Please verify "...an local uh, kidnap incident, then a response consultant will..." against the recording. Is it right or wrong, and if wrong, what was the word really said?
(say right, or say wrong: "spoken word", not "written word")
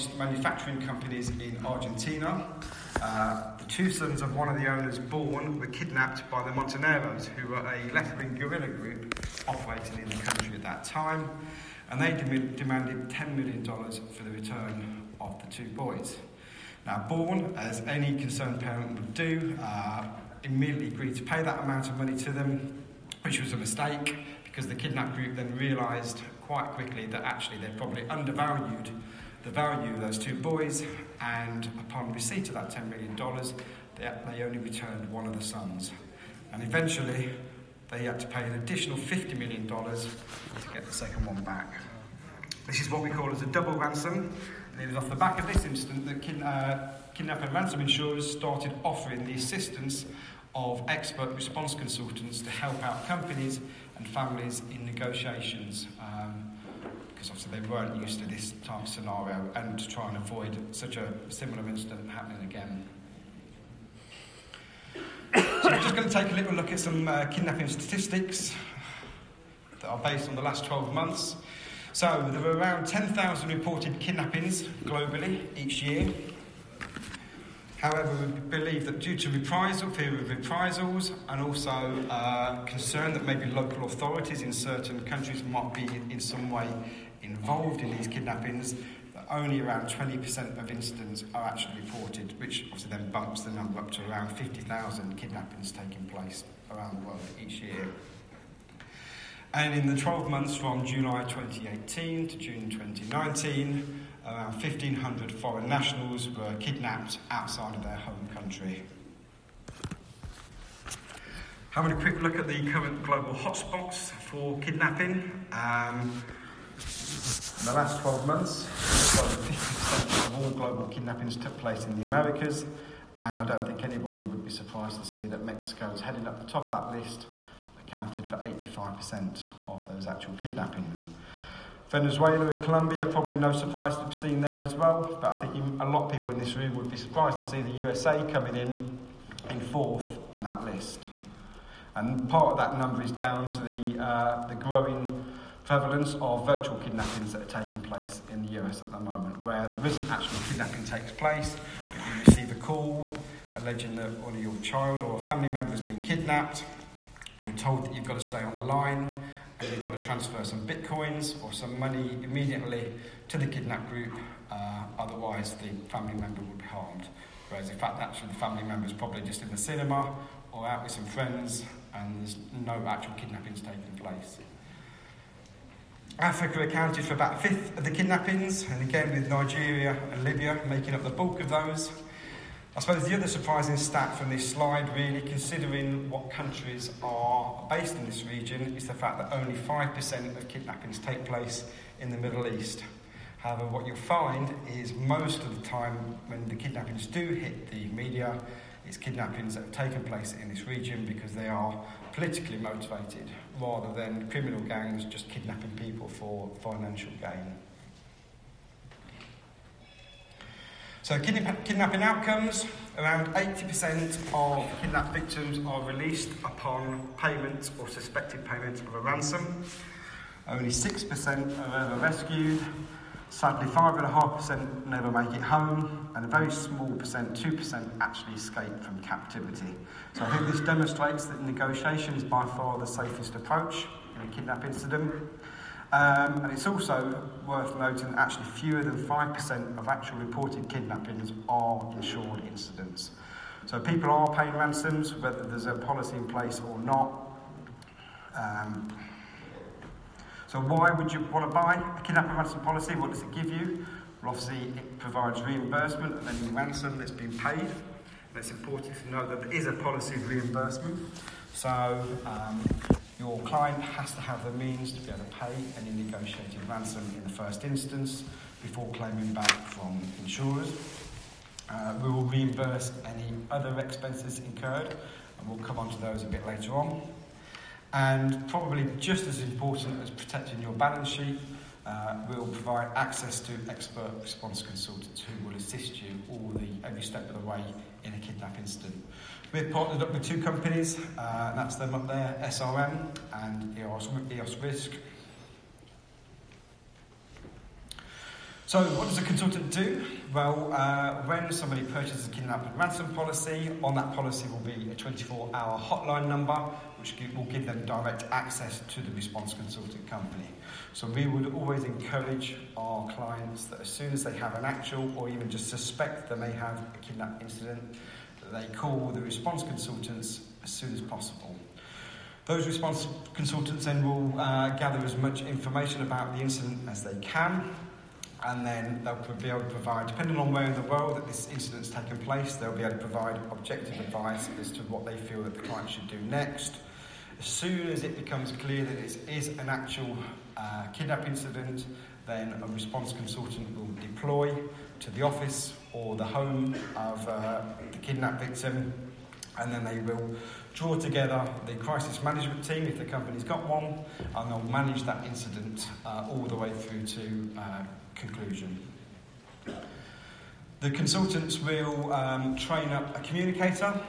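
wrong: "actual", not "local".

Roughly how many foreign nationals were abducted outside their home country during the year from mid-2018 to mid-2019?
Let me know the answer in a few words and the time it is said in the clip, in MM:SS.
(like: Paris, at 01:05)
1,500, at 01:44.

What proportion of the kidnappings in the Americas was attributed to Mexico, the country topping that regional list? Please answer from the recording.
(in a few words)
85%.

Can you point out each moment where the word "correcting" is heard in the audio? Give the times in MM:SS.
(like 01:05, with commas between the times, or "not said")
not said.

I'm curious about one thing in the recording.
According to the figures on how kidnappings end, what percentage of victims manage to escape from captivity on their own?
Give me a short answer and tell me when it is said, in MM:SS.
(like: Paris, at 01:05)
2%, at 03:47.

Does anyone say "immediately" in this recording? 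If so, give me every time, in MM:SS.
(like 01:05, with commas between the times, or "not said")
00:20, 02:42.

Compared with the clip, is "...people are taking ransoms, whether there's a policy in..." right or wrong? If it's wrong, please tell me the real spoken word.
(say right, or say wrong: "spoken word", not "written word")
wrong: "paying", not "taking".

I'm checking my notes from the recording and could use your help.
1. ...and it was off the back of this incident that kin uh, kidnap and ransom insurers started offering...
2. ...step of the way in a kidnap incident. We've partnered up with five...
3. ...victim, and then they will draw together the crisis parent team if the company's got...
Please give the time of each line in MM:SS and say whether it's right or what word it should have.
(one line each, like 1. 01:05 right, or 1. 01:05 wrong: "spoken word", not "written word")
1. 00:44 right
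2. 04:47 wrong: "two", not "five"
3. 05:48 wrong: "management", not "parent".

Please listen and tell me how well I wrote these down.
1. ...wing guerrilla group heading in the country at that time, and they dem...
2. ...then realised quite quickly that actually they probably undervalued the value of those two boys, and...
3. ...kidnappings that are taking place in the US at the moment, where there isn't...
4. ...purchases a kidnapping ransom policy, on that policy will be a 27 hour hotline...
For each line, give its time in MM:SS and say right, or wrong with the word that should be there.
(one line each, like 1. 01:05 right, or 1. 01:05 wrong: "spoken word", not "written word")
1. 00:08 wrong: "operating", not "heading"
2. 00:25 right
3. 02:26 right
4. 05:01 wrong: "24", not "27".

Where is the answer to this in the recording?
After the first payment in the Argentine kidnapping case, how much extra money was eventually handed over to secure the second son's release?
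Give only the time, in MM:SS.
00:38.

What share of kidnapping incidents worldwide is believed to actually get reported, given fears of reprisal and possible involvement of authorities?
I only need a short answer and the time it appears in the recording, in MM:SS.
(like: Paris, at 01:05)
20%, at 01:29.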